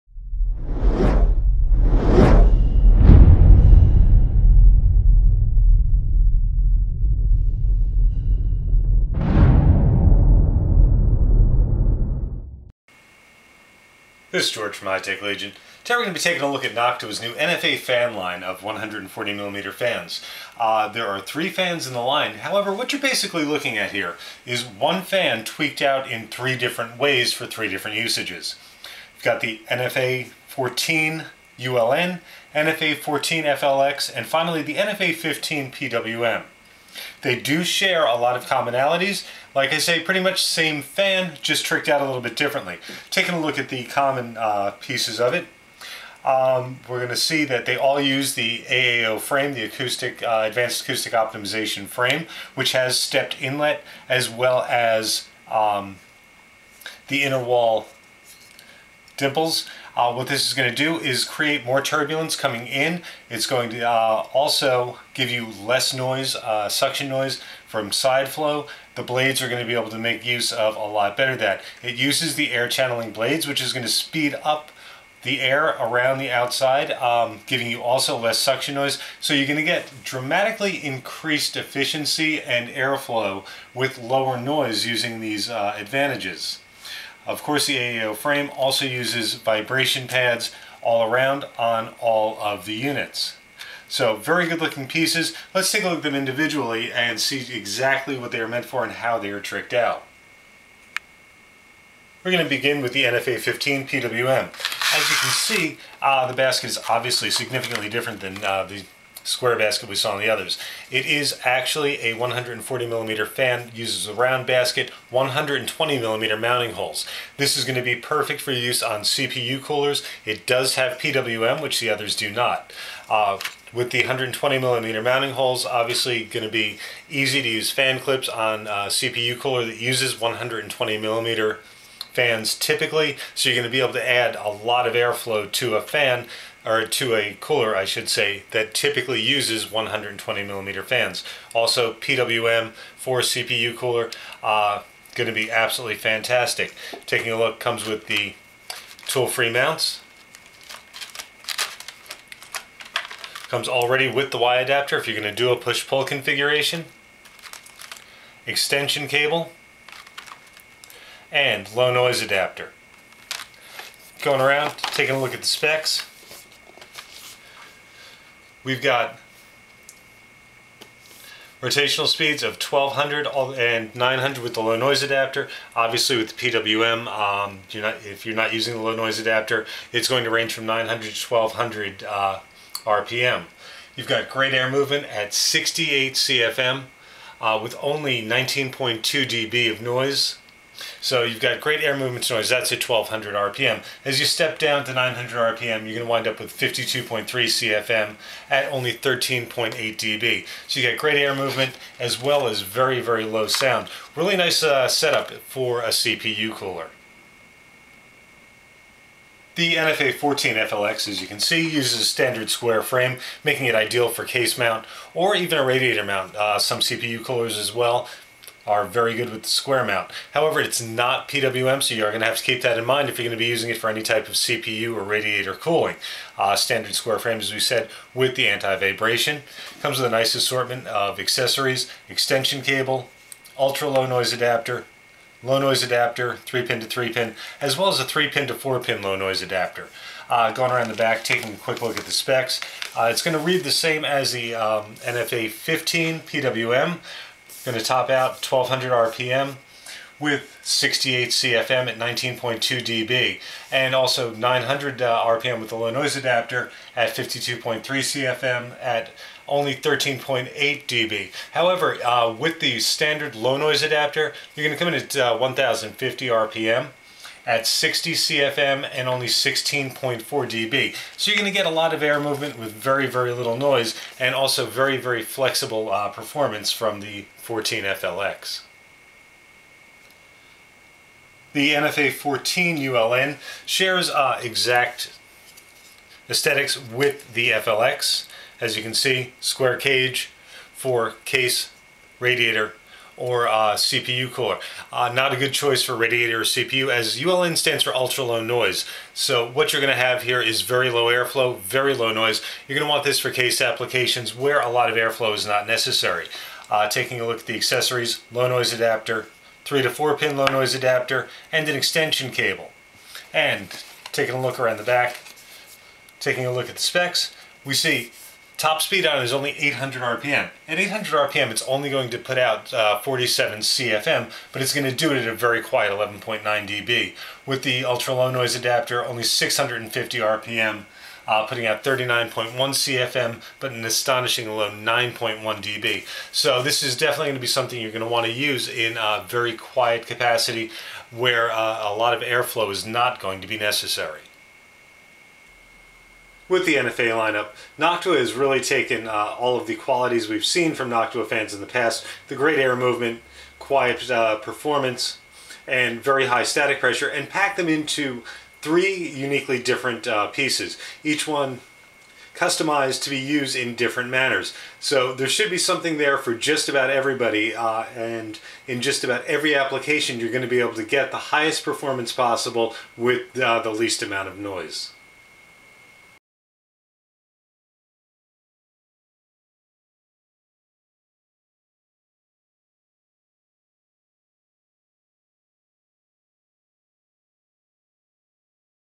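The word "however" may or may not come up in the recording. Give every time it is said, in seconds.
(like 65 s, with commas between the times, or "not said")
22 s, 220 s, 261 s.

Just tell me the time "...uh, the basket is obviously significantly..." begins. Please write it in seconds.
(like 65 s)
106 s.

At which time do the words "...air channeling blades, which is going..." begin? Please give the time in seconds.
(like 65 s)
72 s.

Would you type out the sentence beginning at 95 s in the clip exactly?
Let's take a look at them individually and see exactly what they are meant for and how they are tricked out.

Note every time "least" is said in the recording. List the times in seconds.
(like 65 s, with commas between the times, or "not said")
373 s.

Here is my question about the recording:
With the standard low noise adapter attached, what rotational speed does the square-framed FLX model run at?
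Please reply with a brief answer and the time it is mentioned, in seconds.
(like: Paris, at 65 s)
1050 RPM, at 265 s.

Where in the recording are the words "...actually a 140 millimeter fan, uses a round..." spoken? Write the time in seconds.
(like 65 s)
111 s.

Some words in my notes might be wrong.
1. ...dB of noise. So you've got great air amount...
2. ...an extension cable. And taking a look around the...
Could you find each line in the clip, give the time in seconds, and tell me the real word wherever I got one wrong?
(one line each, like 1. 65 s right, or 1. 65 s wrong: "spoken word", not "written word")
1. 189 s wrong: "movement", not "amount"
2. 311 s right.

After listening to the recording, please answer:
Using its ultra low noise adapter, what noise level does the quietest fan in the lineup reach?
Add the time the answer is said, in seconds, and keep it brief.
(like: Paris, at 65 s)
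9.1 dB, at 334 s.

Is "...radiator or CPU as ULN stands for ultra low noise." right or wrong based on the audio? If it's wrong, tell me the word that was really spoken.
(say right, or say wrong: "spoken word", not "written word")
right.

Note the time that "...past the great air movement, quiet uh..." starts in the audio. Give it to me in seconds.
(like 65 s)
351 s.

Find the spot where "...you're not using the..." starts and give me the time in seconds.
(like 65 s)
178 s.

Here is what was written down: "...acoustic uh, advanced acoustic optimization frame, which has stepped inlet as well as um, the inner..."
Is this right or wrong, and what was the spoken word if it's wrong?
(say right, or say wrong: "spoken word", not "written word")
right.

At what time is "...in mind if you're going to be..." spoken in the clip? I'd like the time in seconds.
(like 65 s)
222 s.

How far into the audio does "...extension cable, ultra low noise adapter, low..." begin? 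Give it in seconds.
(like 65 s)
232 s.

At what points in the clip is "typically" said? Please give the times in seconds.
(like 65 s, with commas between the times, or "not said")
132 s, 138 s.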